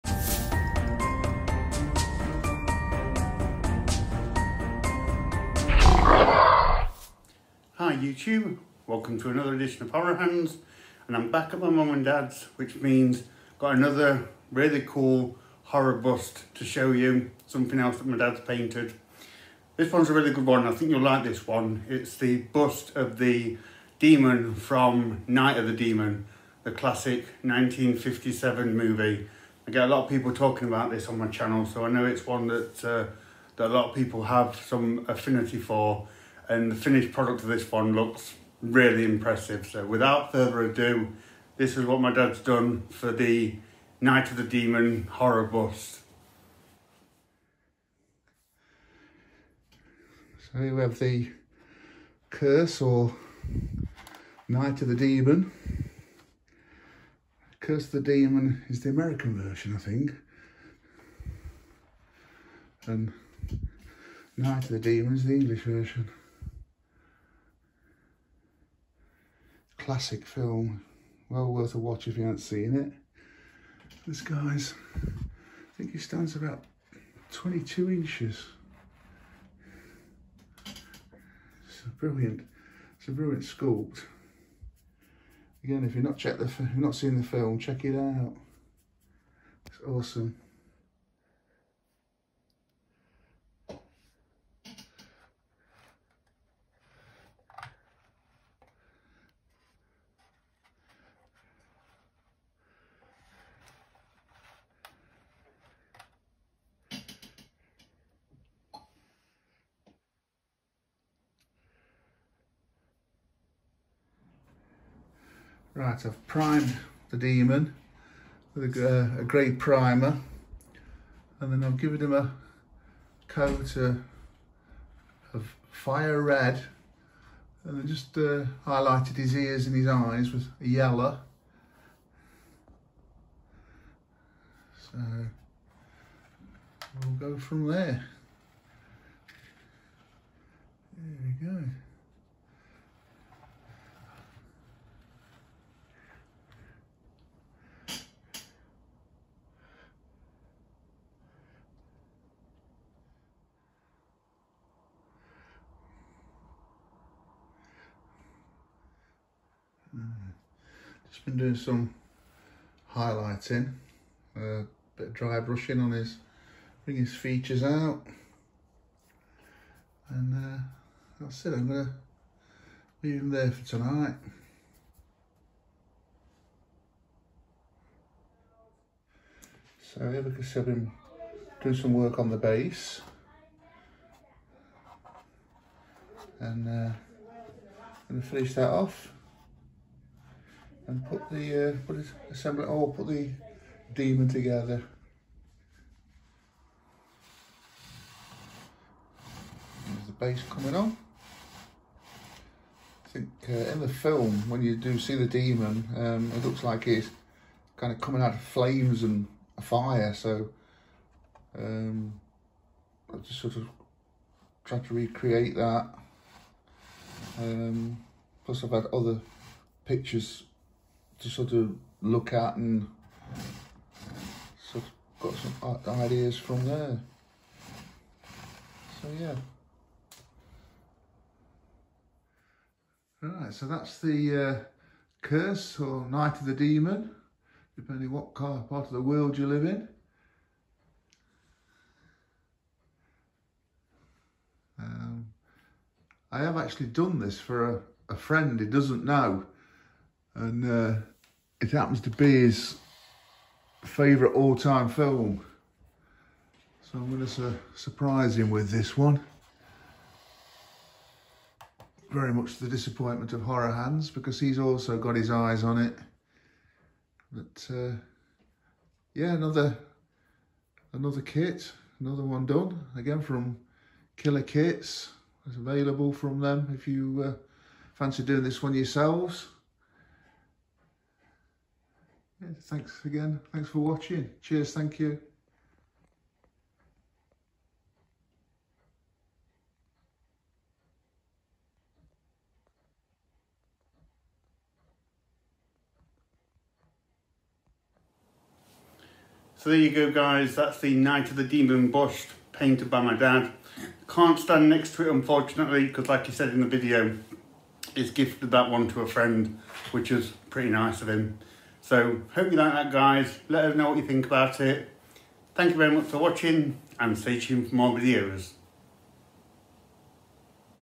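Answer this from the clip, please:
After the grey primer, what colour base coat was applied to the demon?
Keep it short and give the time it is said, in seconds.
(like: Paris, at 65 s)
fire red, at 125 s.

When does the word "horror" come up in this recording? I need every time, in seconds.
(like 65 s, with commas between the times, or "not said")
9 s, 15 s, 45 s, 263 s.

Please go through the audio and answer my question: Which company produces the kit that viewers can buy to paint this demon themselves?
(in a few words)
Killer Kits.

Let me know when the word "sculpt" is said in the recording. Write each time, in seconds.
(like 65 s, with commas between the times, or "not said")
83 s.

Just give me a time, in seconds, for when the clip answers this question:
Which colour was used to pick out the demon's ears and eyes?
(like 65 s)
130 s.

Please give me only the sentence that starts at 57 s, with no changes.
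Curse of the Demon is the American version, I think.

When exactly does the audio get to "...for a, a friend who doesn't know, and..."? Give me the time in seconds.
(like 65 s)
247 s.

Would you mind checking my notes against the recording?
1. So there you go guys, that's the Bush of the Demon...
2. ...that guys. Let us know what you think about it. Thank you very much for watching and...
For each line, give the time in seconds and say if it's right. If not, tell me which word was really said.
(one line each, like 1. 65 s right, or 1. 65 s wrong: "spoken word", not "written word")
1. 299 s wrong: "Night", not "Bush"
2. 312 s right.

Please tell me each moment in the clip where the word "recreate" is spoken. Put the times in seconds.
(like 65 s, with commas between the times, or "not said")
214 s.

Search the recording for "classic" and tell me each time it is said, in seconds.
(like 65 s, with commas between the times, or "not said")
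26 s, 69 s.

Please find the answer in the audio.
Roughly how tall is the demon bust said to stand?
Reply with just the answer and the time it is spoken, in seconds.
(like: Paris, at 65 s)
22 inches, at 77 s.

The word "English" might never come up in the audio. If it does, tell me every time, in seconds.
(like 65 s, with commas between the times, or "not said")
65 s.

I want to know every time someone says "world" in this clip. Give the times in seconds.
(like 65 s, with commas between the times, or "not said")
239 s.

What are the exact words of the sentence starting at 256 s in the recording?
So I'm going to su surprise him with this one.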